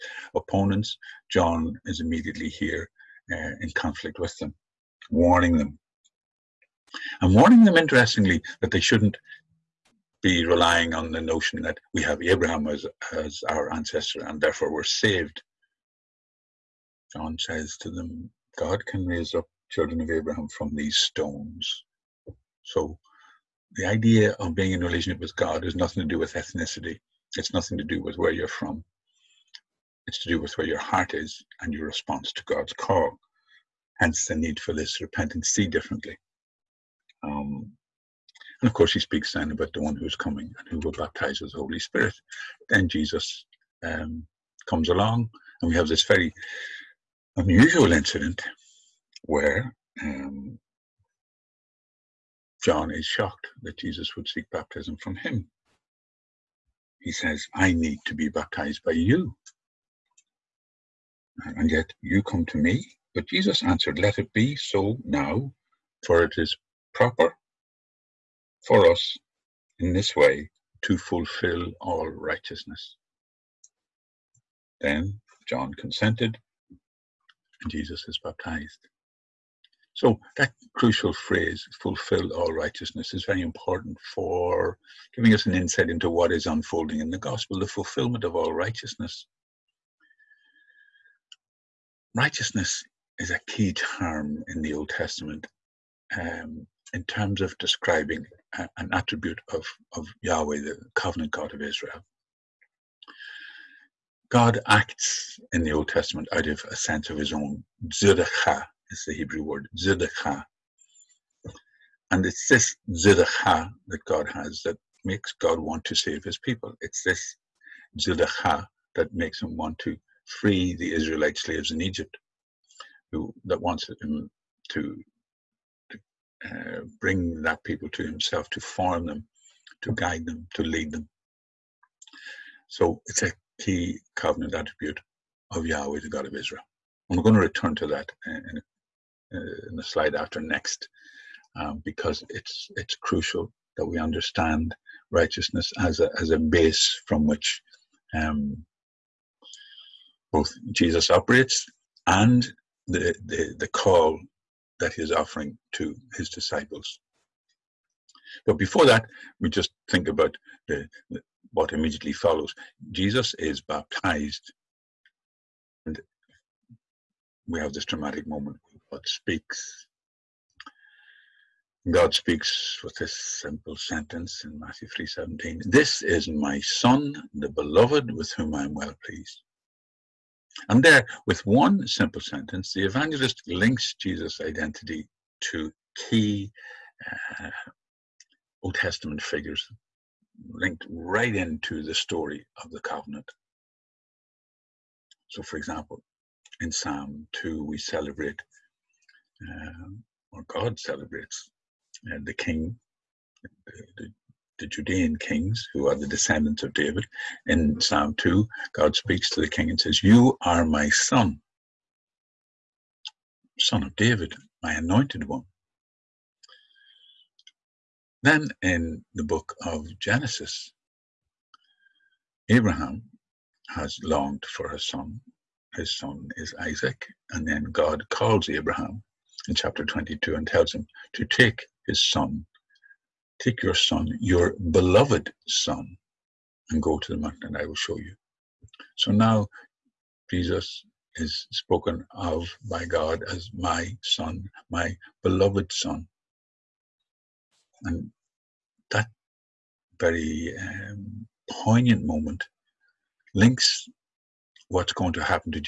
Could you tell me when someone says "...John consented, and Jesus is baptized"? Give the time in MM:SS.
01:15.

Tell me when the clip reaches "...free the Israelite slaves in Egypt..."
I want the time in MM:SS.
02:00.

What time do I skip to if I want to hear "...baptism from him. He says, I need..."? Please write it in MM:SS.
00:54.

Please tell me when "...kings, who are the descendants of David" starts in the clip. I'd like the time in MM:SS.
03:25.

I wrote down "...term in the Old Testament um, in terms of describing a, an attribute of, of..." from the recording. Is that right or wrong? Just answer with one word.
right.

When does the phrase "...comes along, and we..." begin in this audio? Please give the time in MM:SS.
00:44.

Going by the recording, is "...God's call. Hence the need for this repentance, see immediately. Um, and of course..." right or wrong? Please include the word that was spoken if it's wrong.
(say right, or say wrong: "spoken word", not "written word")
wrong: "differently", not "immediately".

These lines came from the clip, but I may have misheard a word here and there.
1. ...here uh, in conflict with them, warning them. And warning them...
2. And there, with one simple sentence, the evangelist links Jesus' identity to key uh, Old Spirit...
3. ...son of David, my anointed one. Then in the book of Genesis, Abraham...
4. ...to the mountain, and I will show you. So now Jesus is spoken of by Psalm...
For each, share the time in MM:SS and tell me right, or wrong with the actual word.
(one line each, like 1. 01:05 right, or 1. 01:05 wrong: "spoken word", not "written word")
1. 00:02 right
2. 03:00 wrong: "Testament", not "Spirit"
3. 03:33 right
4. 03:56 wrong: "God", not "Psalm".